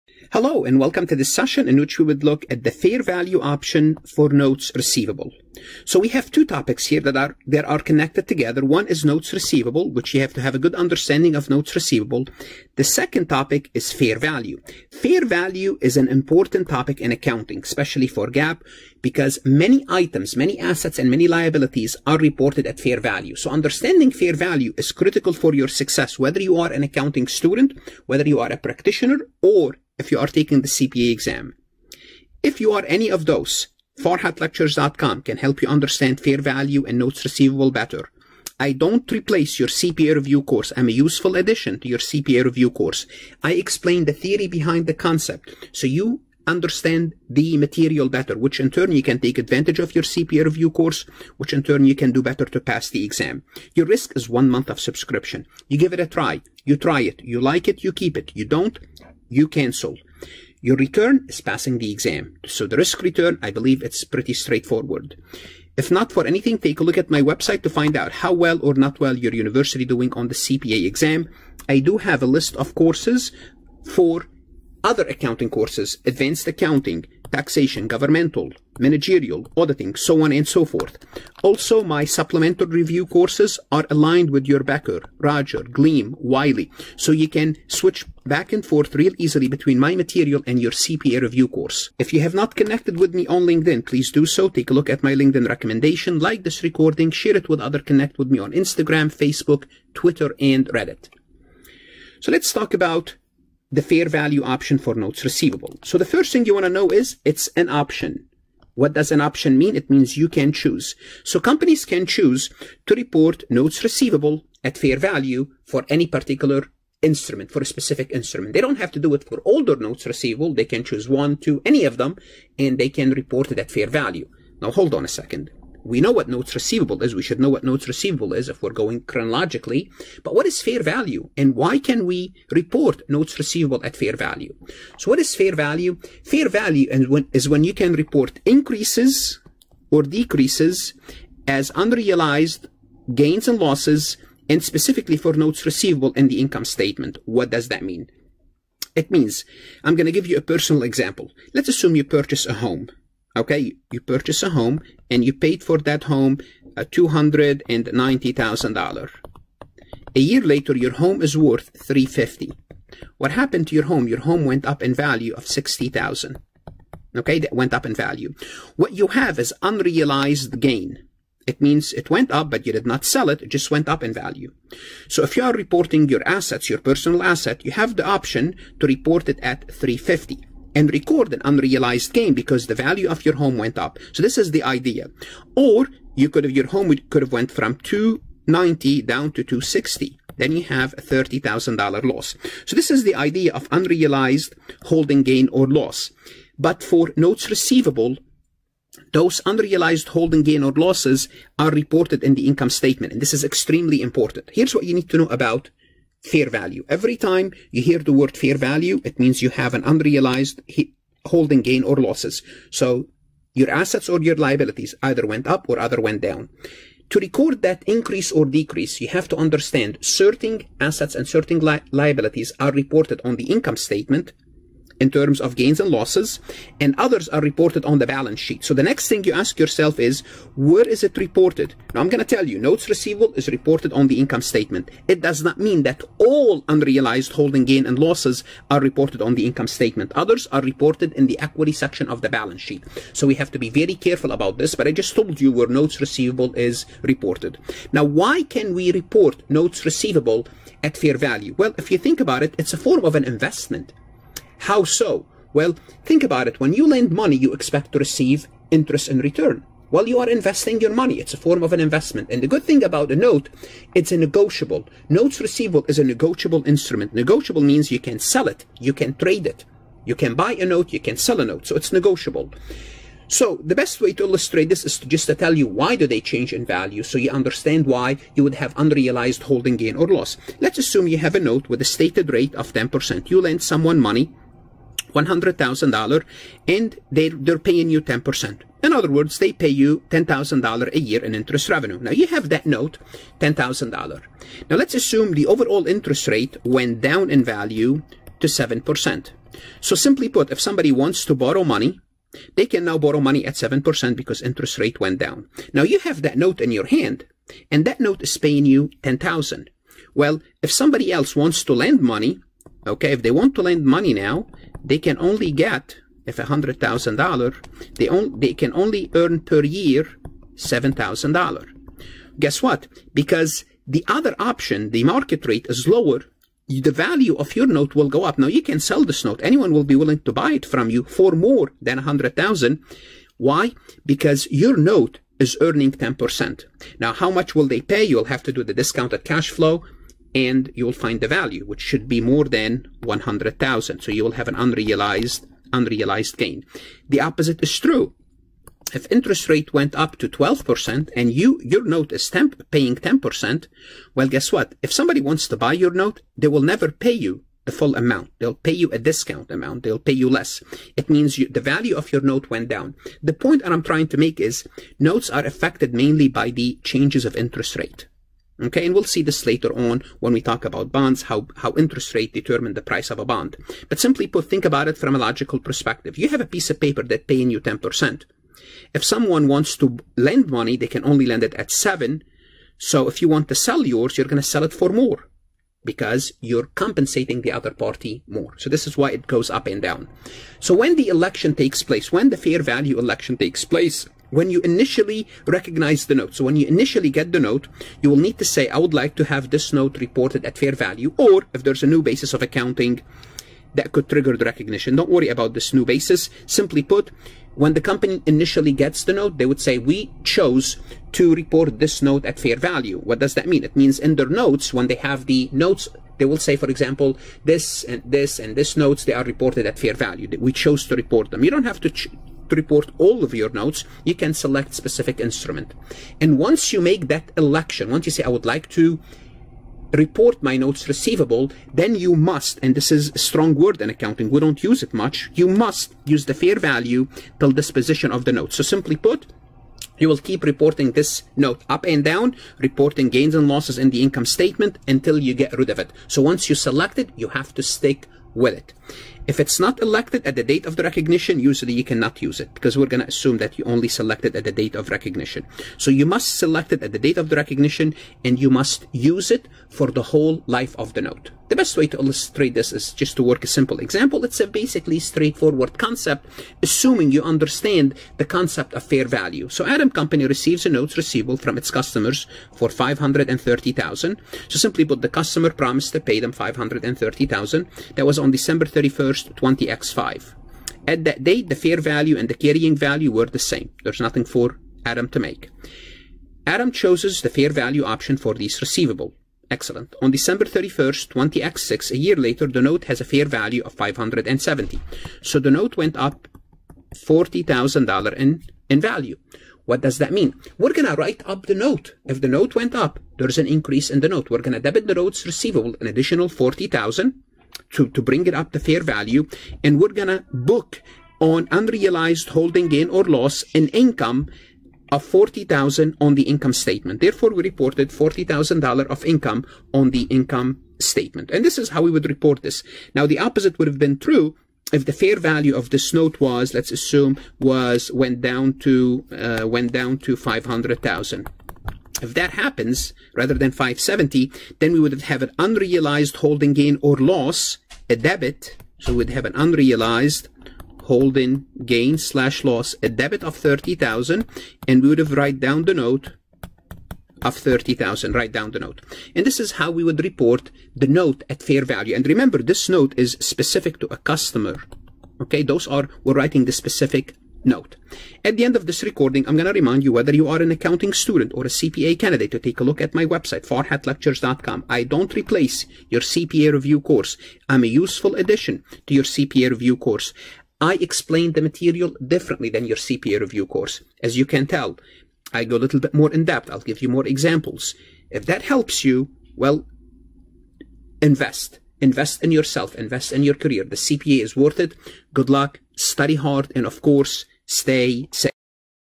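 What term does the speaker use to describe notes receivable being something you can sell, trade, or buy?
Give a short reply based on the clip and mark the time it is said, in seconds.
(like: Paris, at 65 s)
negotiable instrument, at 266 s.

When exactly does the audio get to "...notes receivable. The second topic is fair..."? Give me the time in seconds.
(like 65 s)
11 s.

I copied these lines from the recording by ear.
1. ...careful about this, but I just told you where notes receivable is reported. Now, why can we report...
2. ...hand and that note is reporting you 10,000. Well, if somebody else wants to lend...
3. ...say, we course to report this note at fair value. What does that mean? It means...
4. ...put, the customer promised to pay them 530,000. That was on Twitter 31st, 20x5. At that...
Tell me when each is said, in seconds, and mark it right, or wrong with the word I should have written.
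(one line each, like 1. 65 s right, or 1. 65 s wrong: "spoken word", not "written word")
1. 243 s right
2. 306 s wrong: "paying", not "reporting"
3. 409 s wrong: "chose", not "course"
4. 474 s wrong: "December", not "Twitter".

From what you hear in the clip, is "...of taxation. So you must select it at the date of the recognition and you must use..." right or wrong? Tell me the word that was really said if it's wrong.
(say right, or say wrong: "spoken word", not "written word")
wrong: "recognition", not "taxation".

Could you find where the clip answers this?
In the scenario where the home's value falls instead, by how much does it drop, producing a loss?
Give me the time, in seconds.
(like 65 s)
191 s.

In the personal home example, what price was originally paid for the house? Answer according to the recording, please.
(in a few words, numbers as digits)
$290,000.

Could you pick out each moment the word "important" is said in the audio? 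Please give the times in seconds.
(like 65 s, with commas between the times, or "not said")
16 s, 204 s.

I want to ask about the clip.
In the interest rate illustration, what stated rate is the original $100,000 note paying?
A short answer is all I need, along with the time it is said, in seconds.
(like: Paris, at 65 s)
10%, at 281 s.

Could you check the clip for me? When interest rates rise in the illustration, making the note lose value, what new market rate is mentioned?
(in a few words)
12%.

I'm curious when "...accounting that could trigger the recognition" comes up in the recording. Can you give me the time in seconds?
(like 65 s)
402 s.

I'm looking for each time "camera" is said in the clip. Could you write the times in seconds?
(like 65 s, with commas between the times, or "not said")
not said.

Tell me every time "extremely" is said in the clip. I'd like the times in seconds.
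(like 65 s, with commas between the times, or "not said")
203 s.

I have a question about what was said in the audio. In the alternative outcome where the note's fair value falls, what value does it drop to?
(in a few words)
500,000.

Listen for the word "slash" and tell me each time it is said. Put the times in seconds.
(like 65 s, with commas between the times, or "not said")
541 s.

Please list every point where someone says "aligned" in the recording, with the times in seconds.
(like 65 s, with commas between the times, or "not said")
83 s.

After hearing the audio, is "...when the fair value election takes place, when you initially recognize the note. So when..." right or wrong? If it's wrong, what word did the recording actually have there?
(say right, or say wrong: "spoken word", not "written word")
right.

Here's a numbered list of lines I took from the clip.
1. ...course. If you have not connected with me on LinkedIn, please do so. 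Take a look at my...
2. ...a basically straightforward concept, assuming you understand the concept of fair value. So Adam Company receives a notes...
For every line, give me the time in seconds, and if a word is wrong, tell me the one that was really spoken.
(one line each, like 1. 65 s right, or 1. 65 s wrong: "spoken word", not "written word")
1. 91 s right
2. 464 s right.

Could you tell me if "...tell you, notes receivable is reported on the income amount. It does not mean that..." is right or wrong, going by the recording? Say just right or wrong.
wrong.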